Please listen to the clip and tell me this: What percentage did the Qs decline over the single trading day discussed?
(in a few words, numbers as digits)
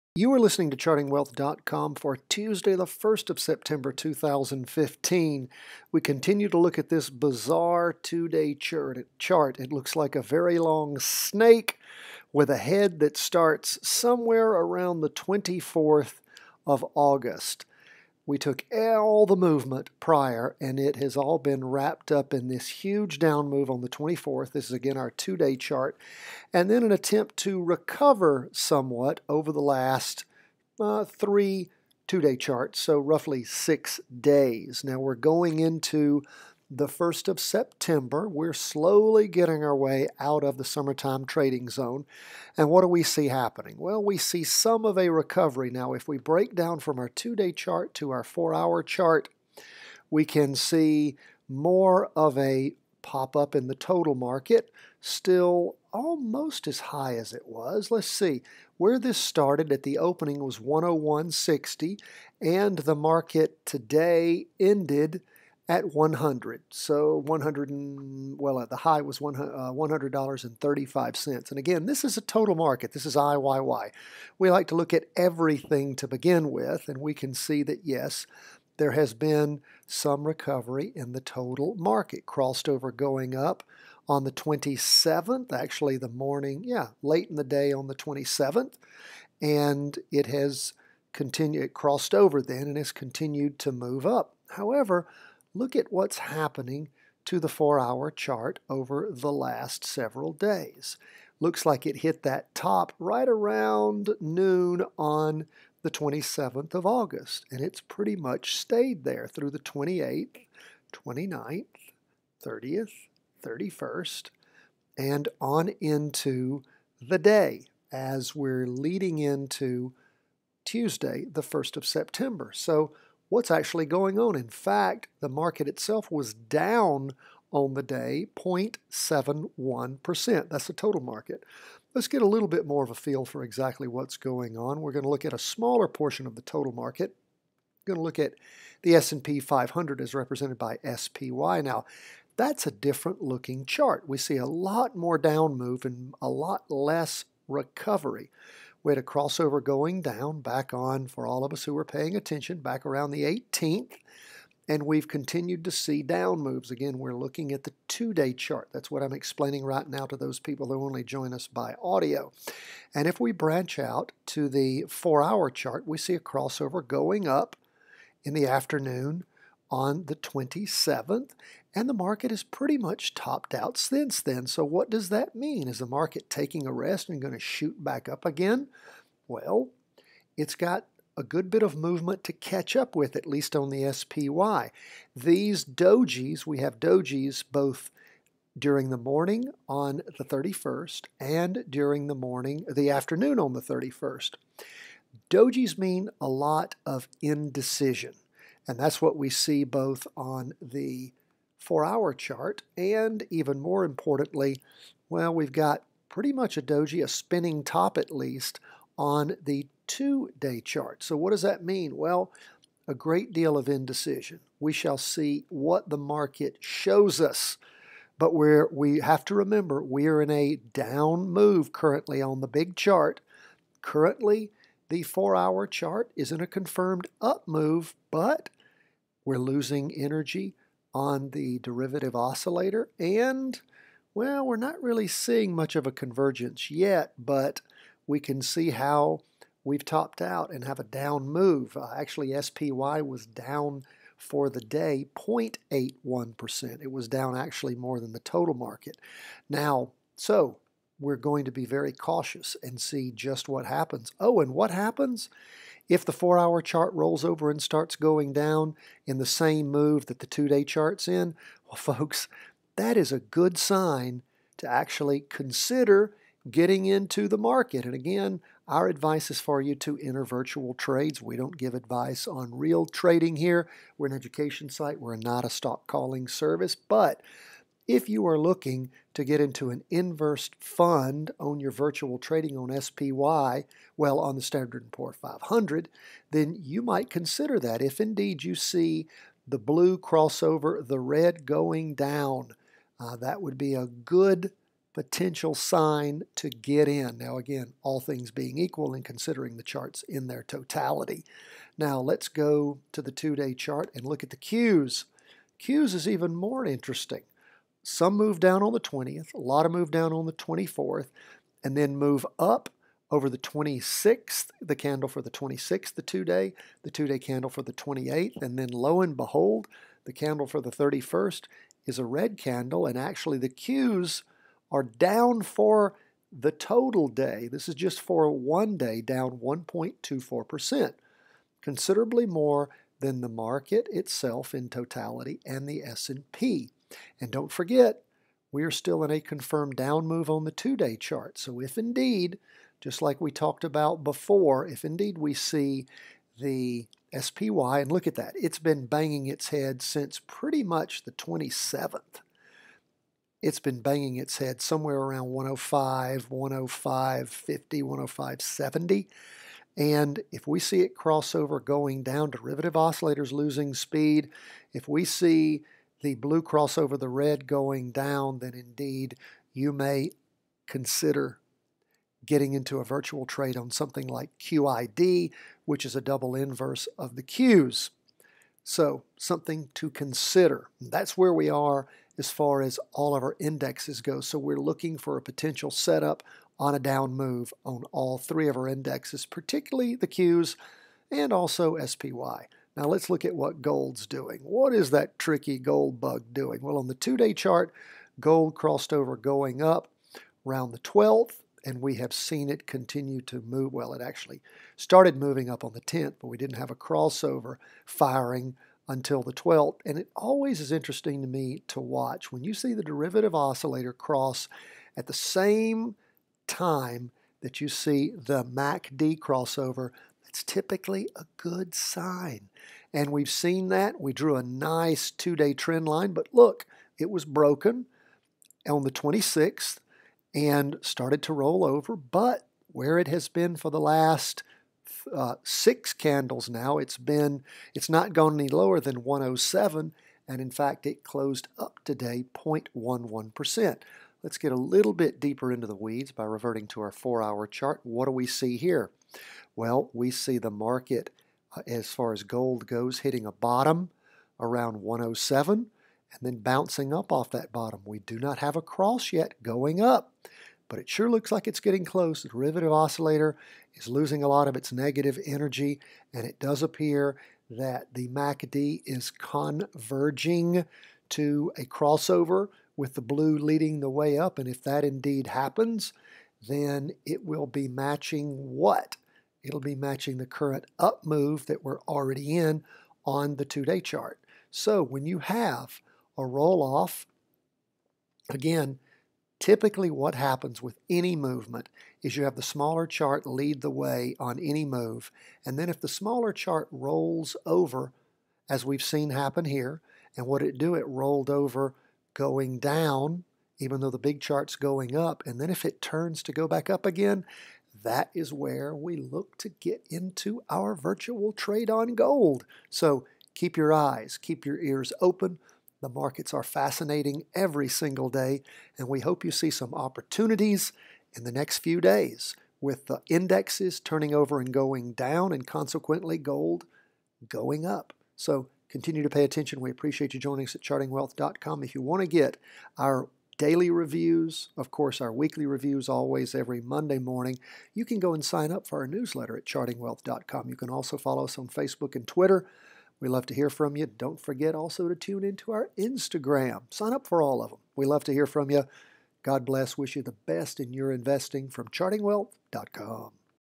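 1.24%.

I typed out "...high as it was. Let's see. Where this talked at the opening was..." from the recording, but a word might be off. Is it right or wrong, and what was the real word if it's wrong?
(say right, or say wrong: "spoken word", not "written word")
wrong: "started", not "talked".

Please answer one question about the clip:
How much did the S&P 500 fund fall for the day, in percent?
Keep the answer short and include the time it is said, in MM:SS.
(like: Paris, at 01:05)
0.81%, at 04:05.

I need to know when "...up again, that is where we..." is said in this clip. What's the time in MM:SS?
08:26.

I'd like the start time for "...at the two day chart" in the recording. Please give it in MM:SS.
02:37.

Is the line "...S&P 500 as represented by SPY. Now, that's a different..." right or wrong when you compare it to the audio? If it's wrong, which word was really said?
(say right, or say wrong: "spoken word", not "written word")
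right.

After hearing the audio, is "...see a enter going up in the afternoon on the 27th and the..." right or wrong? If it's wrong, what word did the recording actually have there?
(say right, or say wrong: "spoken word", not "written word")
wrong: "crossover", not "enter".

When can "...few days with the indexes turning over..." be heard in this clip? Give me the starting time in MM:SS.
08:41.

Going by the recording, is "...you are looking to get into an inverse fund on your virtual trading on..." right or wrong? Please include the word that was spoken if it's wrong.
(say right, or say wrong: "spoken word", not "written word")
right.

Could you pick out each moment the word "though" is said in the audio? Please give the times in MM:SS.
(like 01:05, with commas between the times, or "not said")
08:23.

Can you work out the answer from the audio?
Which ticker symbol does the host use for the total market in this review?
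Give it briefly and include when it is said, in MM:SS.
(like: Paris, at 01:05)
IYY, at 01:13.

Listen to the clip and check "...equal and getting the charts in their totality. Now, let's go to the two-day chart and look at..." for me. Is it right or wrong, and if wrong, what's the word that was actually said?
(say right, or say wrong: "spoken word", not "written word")
wrong: "considering", not "getting".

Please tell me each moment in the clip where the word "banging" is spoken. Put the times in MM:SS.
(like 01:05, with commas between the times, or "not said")
05:48, 05:53.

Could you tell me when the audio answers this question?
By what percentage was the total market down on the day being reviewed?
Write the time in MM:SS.
02:08.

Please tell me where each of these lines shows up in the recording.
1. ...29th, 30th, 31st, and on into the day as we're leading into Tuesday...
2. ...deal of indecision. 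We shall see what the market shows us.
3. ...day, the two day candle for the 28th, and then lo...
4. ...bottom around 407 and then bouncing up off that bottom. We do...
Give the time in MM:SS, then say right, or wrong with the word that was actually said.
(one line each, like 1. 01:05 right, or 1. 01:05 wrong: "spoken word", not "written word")
1. 01:50 right
2. 03:33 right
3. 05:16 right
4. 07:33 wrong: "107", not "407".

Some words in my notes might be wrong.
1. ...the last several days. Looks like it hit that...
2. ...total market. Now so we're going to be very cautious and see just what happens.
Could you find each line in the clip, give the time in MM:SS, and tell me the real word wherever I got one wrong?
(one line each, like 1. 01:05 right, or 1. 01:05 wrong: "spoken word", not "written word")
1. 01:39 right
2. 04:08 right.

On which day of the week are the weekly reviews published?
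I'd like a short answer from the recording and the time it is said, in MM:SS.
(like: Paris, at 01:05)
Monday, at 08:56.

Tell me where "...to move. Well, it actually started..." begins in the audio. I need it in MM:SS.
06:43.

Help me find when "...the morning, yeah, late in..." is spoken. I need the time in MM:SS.
01:25.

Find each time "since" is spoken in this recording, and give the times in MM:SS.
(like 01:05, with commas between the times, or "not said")
02:53, 05:49.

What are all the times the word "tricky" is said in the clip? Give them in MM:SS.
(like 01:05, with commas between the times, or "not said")
06:35.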